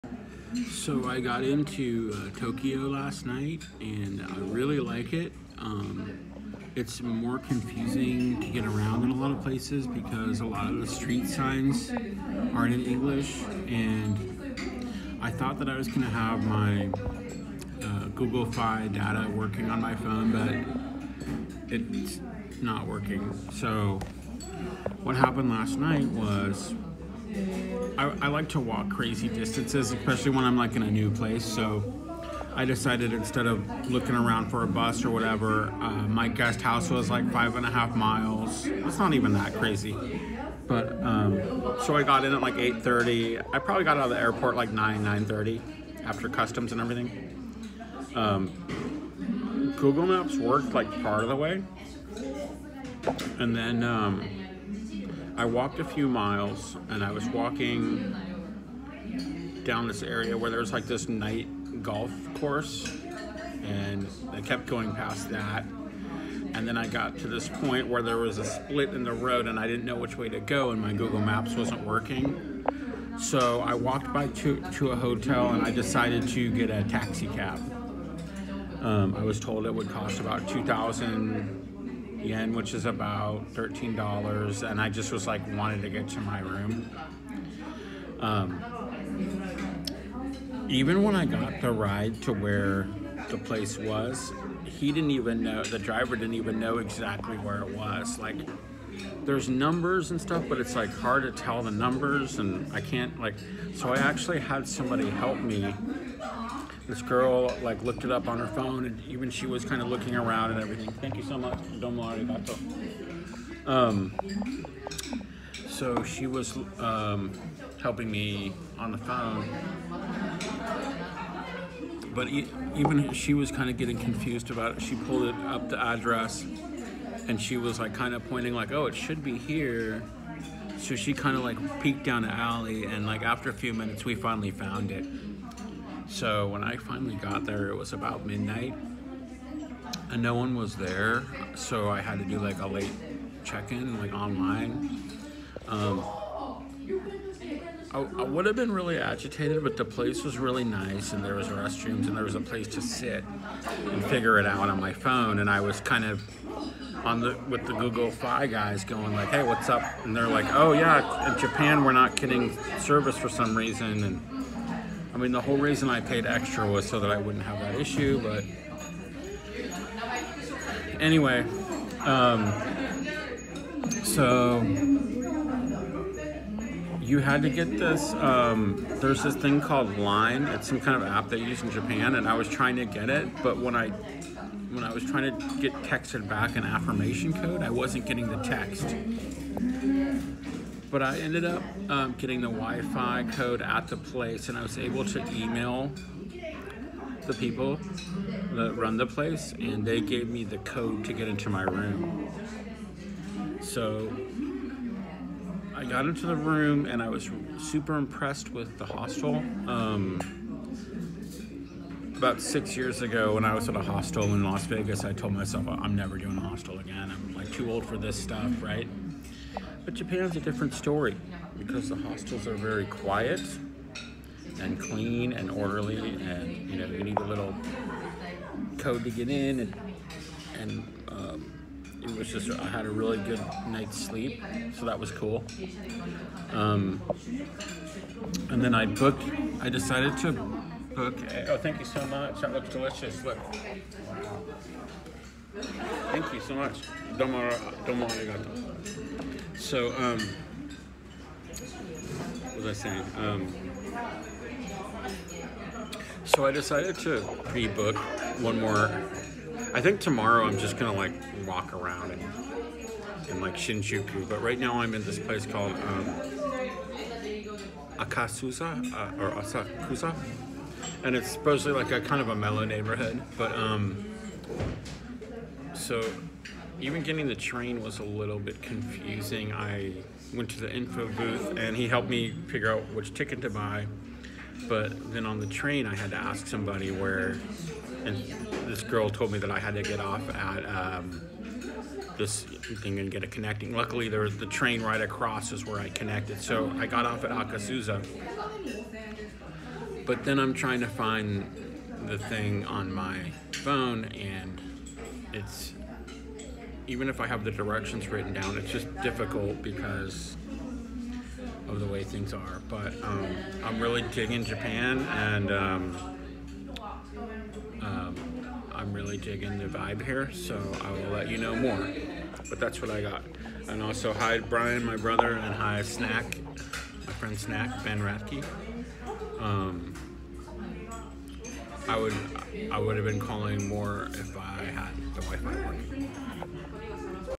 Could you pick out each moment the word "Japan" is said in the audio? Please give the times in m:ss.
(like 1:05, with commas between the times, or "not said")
2:41, 3:01, 3:39, 5:14.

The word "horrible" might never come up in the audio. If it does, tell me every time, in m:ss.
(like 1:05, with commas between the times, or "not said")
not said.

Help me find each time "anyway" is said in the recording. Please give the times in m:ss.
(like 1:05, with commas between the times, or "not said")
2:51.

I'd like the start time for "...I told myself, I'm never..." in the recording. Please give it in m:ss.
3:35.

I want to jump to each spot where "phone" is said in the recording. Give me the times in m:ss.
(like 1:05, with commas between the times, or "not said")
0:19, 1:48, 1:58, 2:34, 5:03.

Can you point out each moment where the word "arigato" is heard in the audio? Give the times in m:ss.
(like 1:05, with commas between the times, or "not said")
4:08.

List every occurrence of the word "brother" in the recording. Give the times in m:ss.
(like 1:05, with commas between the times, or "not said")
5:24.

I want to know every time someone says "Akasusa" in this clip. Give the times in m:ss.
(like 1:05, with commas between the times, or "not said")
4:27, 4:57.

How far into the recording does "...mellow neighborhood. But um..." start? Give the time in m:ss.
4:32.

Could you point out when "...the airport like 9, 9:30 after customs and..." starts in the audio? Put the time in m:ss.
0:44.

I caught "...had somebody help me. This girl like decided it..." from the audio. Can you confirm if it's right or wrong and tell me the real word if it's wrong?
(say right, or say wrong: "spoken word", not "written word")
wrong: "looked", not "decided".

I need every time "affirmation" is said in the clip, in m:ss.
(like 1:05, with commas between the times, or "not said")
3:06.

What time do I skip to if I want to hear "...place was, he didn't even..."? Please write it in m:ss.
1:33.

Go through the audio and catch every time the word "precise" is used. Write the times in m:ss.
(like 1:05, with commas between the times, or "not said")
not said.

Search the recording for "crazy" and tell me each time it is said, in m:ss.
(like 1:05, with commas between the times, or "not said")
0:28, 0:39.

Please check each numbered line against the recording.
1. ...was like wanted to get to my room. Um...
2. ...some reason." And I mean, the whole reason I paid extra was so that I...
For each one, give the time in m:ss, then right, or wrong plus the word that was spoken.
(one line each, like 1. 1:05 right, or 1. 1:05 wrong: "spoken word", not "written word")
1. 1:25 right
2. 2:43 right.